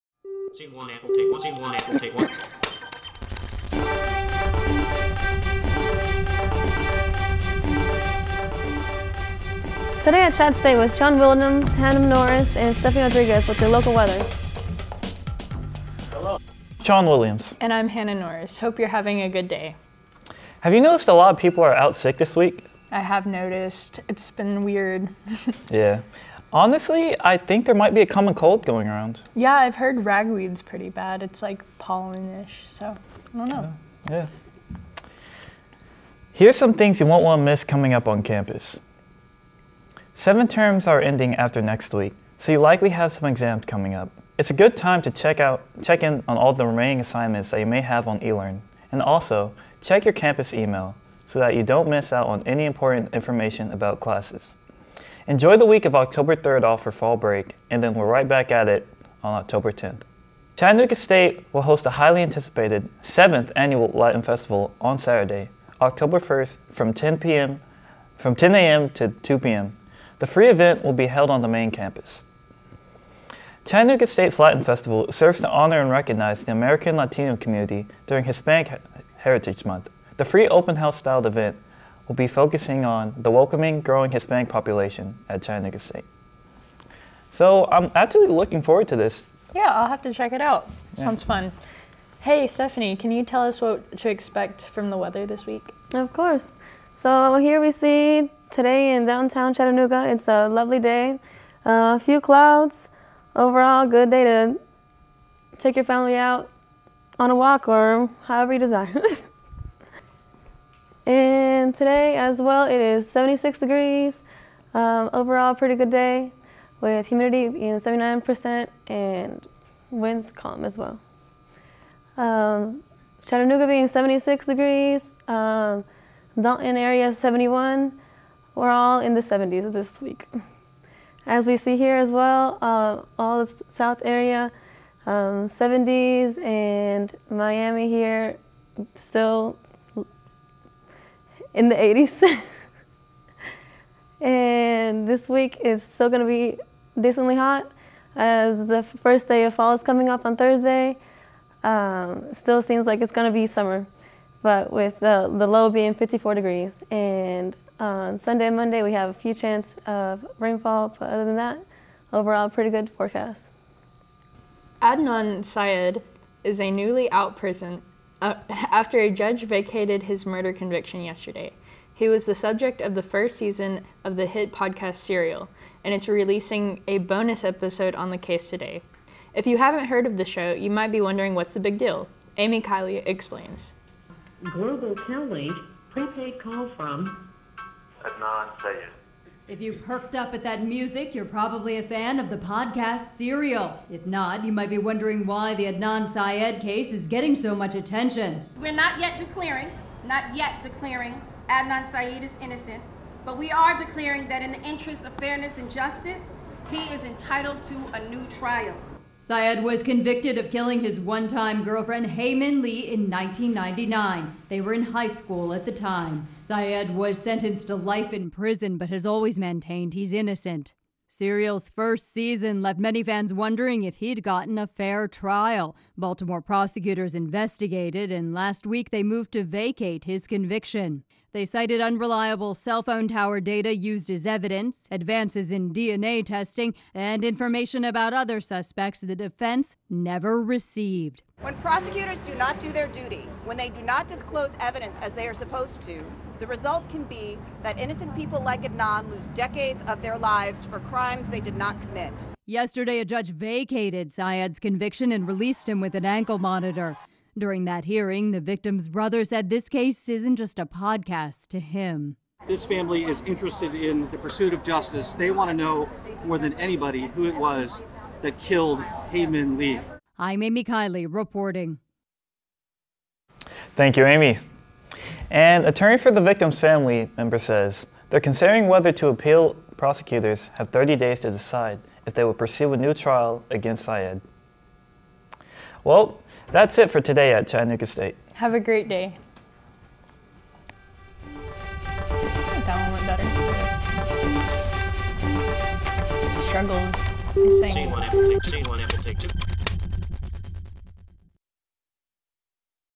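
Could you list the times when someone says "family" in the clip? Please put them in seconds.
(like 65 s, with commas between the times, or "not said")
105 s, 262 s, 276 s.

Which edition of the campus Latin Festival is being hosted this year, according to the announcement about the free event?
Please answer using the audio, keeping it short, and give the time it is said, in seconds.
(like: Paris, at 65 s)
7th, at 63 s.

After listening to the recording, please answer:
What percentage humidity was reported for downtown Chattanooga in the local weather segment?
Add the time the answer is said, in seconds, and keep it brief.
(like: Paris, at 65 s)
79%, at 117 s.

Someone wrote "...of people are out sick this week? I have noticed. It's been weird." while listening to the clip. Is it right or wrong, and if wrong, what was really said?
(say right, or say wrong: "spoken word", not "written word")
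right.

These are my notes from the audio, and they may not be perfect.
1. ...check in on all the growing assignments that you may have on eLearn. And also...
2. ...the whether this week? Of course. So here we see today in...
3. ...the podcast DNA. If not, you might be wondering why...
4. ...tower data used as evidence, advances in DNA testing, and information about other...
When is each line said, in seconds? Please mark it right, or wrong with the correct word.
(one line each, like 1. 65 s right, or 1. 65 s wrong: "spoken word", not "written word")
1. 45 s wrong: "remaining", not "growing"
2. 94 s wrong: "weather", not "whether"
3. 192 s wrong: "Serial", not "DNA"
4. 233 s right.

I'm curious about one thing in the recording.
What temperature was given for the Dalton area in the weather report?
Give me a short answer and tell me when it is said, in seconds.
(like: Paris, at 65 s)
71, at 126 s.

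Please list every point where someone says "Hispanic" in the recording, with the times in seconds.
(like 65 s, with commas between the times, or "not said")
78 s, 84 s.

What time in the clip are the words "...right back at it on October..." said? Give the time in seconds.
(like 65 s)
58 s.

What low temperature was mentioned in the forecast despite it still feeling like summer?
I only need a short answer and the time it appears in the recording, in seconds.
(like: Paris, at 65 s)
54 degrees, at 155 s.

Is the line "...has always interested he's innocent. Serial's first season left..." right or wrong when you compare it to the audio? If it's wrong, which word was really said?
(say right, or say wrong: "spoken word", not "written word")
wrong: "maintained", not "interested".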